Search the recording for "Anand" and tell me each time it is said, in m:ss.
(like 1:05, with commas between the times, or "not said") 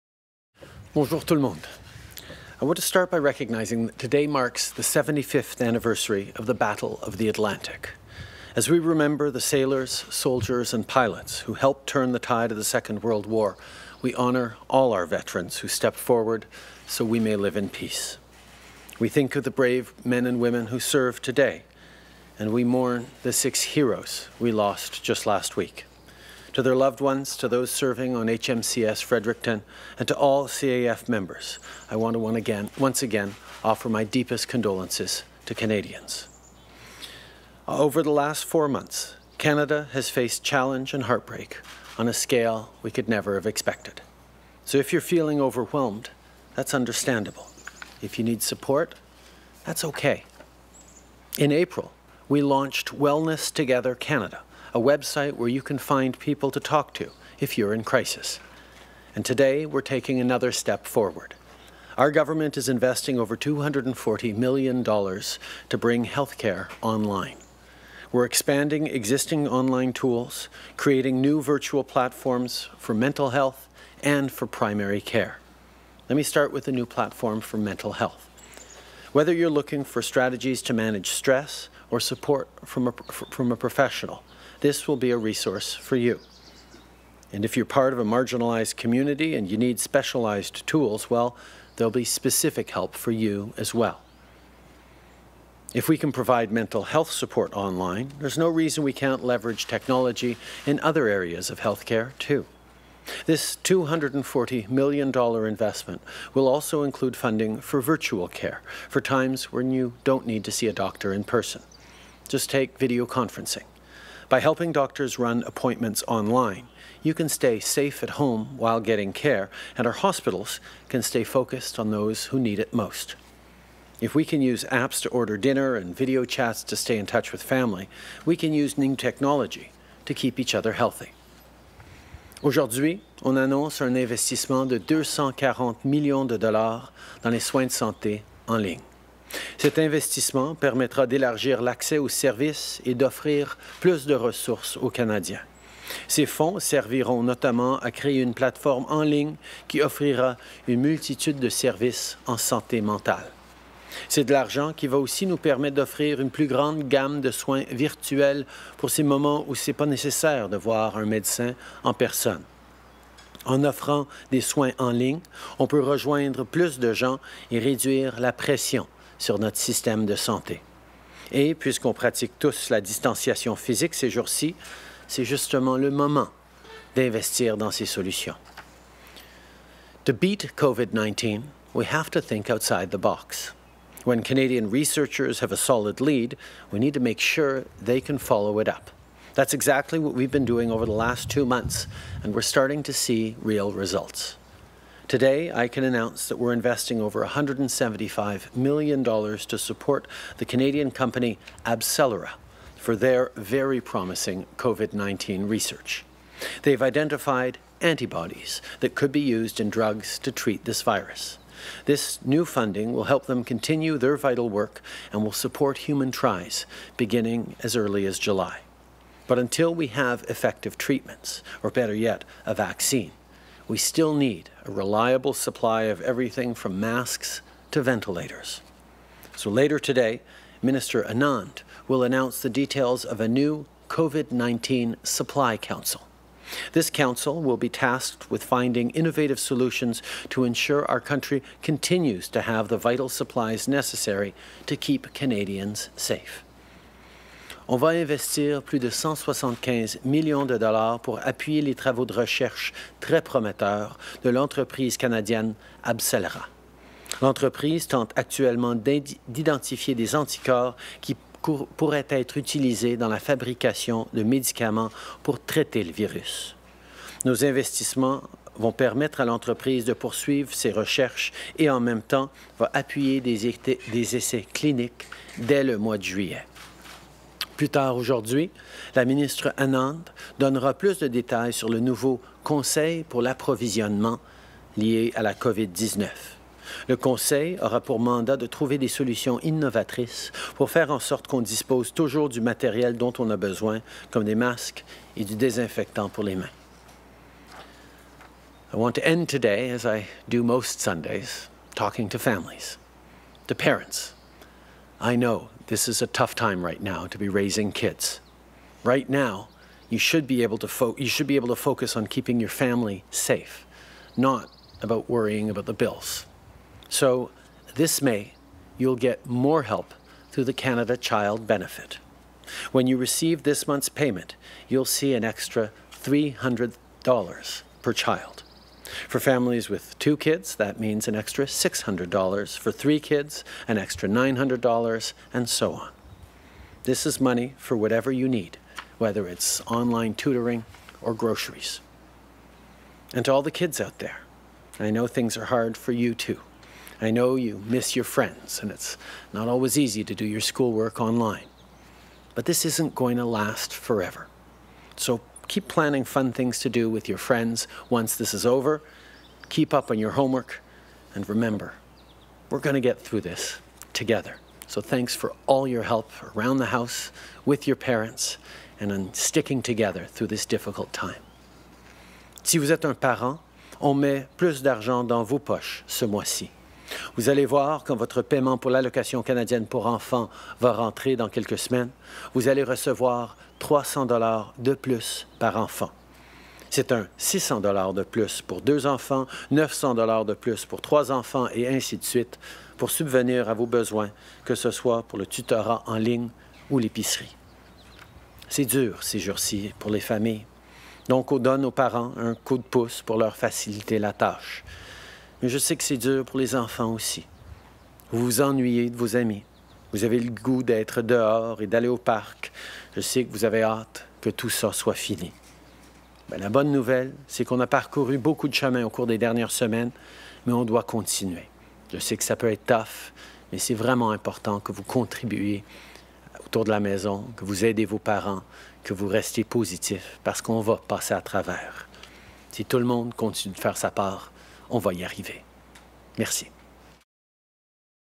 3:51, 4:39.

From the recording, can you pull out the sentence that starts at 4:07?
On va investir plus de 175 millions de dollars pour appuyer les travaux de recherche très prometteurs de l'entreprise canadienne Abcelera.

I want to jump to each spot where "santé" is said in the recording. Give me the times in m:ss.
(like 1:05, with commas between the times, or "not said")
2:17, 2:32, 2:50.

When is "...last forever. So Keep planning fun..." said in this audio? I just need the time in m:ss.
5:53.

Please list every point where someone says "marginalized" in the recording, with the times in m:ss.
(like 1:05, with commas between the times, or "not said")
1:28.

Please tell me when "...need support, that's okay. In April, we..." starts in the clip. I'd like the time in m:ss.
0:48.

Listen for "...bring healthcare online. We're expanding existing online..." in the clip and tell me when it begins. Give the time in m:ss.
1:05.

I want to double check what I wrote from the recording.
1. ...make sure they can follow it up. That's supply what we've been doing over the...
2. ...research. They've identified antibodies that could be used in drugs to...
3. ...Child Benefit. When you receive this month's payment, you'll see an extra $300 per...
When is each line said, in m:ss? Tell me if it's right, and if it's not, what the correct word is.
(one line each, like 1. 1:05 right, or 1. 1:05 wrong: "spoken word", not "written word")
1. 3:06 wrong: "exactly", not "supply"
2. 3:25 right
3. 5:20 right.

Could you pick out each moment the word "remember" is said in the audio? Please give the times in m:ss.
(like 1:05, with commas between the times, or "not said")
0:08, 6:01.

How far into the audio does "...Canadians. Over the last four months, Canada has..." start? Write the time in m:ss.
0:35.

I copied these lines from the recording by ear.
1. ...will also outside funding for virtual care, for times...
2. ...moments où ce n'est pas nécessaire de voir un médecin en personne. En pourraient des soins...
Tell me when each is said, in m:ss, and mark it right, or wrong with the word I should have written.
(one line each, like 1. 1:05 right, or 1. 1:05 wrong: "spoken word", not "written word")
1. 1:46 wrong: "include", not "outside"
2. 2:39 wrong: "offrant", not "pourraient".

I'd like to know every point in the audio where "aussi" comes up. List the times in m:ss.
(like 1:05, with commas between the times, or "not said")
2:34, 6:46.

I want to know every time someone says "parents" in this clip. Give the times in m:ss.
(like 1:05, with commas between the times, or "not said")
5:03, 6:07, 6:12, 6:41, 7:07.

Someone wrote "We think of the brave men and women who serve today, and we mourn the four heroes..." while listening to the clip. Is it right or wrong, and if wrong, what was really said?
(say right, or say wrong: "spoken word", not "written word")
wrong: "six", not "four".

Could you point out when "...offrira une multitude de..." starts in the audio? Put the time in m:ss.
2:29.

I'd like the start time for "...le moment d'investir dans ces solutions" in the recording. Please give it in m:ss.
2:55.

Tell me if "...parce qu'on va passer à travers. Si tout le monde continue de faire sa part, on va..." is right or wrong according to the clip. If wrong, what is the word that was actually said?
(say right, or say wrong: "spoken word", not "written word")
right.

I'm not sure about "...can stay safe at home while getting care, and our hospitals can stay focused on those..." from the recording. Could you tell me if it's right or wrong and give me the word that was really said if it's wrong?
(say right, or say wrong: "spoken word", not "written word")
right.